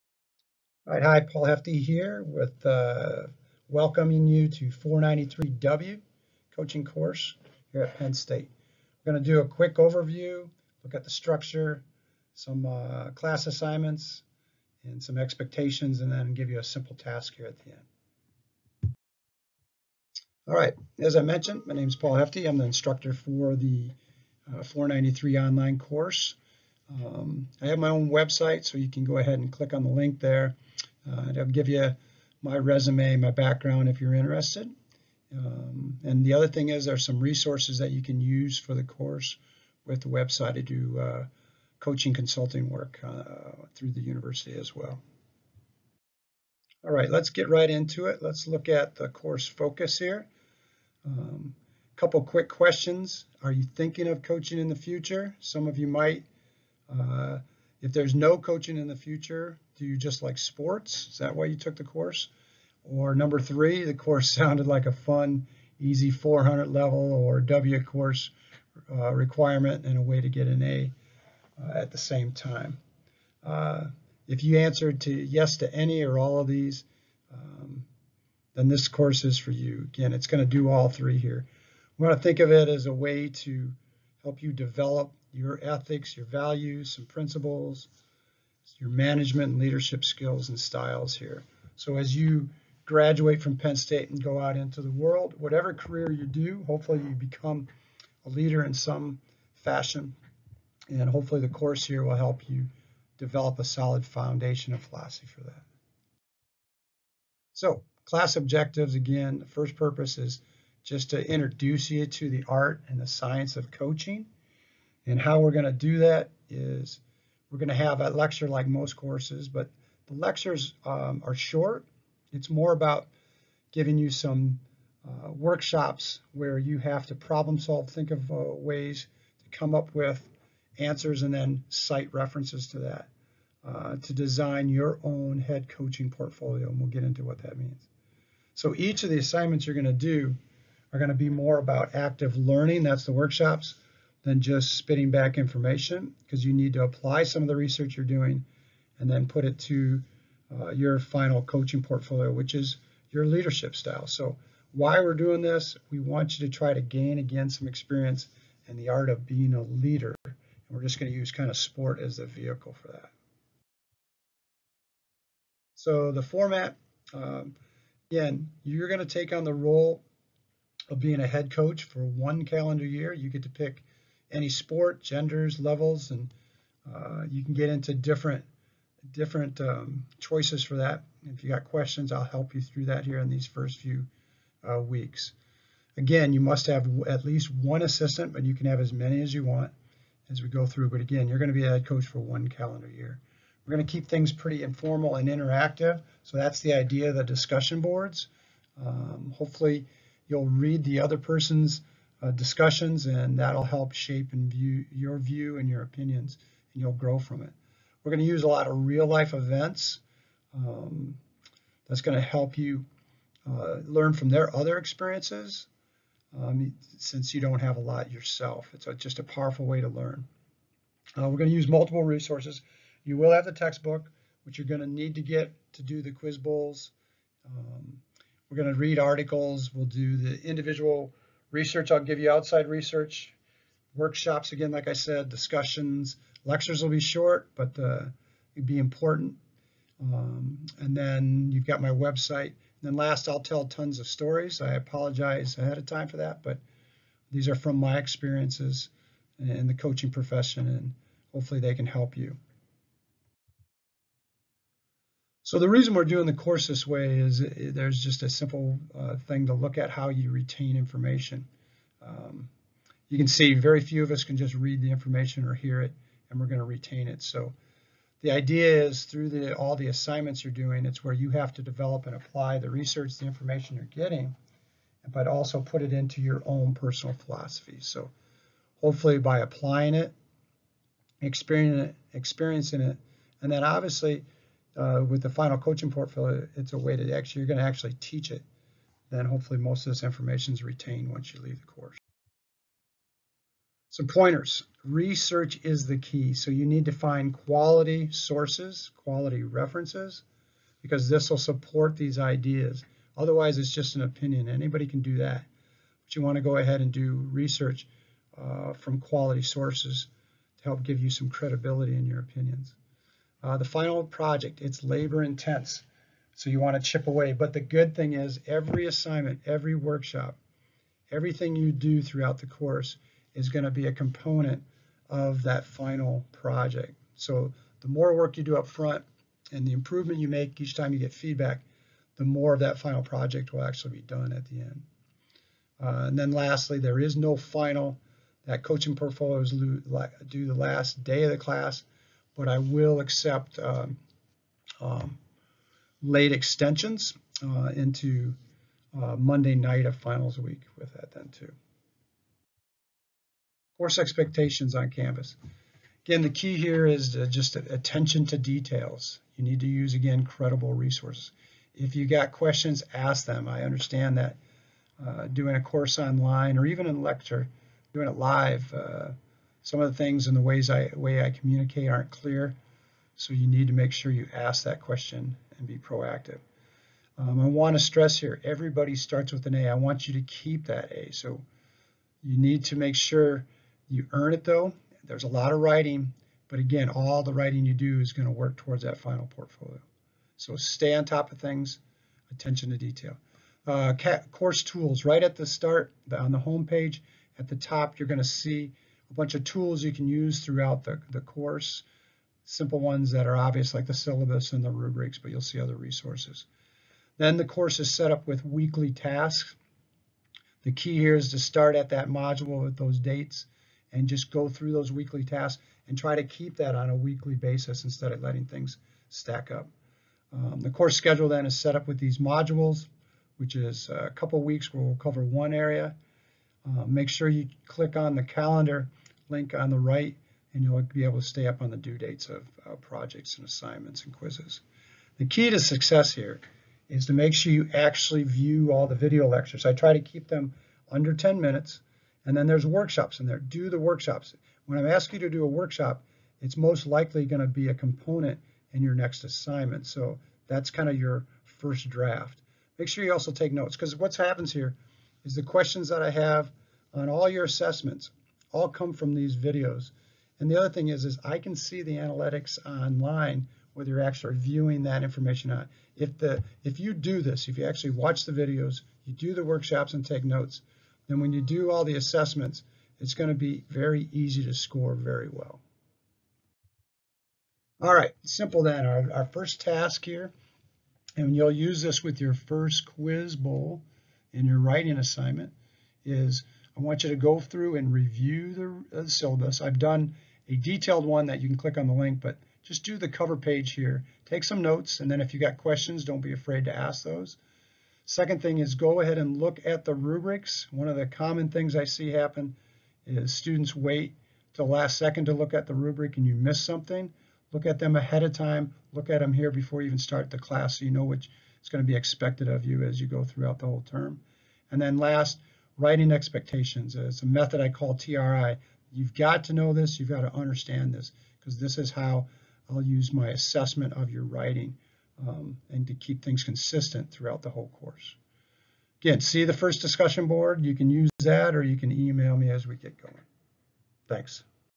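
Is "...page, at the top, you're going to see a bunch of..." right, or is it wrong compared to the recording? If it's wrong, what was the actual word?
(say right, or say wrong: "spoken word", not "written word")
right.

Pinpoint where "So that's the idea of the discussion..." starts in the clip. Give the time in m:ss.
3:16.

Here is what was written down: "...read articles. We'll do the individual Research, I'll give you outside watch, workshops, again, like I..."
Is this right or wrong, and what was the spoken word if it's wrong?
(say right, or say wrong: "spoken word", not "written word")
wrong: "research", not "watch".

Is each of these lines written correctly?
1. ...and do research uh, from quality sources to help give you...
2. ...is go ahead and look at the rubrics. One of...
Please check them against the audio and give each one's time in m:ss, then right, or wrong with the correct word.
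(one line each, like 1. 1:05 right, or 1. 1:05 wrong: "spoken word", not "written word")
1. 5:06 right
2. 8:18 right.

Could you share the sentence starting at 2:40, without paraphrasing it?
And we're just going to use kind of sport as the vehicle for that.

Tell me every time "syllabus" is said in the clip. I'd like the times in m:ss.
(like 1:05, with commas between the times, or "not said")
6:43, 8:09.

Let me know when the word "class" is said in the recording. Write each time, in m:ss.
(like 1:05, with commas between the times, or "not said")
0:13, 1:48, 5:41, 8:30.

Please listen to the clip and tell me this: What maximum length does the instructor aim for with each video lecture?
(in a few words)
Under 10 minutes.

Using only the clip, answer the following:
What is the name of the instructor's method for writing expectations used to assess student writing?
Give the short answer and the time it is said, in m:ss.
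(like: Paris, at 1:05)
TRI, at 8:37.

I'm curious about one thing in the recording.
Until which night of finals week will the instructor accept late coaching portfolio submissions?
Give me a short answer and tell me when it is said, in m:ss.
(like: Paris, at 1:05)
Monday night, at 5:49.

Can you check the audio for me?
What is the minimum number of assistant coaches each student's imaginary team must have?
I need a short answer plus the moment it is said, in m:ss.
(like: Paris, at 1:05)
1, at 3:07.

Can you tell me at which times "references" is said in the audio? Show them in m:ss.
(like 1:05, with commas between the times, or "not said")
2:12, 4:59.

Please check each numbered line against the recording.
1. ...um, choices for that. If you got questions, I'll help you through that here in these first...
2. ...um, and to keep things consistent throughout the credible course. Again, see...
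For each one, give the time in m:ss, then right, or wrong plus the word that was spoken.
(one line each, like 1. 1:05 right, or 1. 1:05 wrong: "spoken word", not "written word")
1. 2:59 right
2. 8:45 wrong: "whole", not "credible".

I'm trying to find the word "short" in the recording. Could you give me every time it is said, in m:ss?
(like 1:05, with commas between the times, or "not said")
2:01, 3:57.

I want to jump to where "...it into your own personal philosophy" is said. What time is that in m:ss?
4:35.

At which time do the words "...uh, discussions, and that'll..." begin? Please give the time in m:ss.
3:22.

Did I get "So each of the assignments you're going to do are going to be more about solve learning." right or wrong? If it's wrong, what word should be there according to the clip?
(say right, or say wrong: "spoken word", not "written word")
wrong: "active", not "solve".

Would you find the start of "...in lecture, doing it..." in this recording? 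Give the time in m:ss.
6:06.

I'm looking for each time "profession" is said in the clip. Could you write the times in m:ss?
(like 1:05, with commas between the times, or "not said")
4:10.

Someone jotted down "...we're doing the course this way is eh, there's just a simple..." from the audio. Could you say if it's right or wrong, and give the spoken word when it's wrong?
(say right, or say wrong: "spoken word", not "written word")
right.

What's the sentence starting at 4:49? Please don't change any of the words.
Then hopefully most of this information is retained once you leave the course.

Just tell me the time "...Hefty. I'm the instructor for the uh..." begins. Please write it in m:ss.
0:22.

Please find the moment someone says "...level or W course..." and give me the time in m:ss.
1:06.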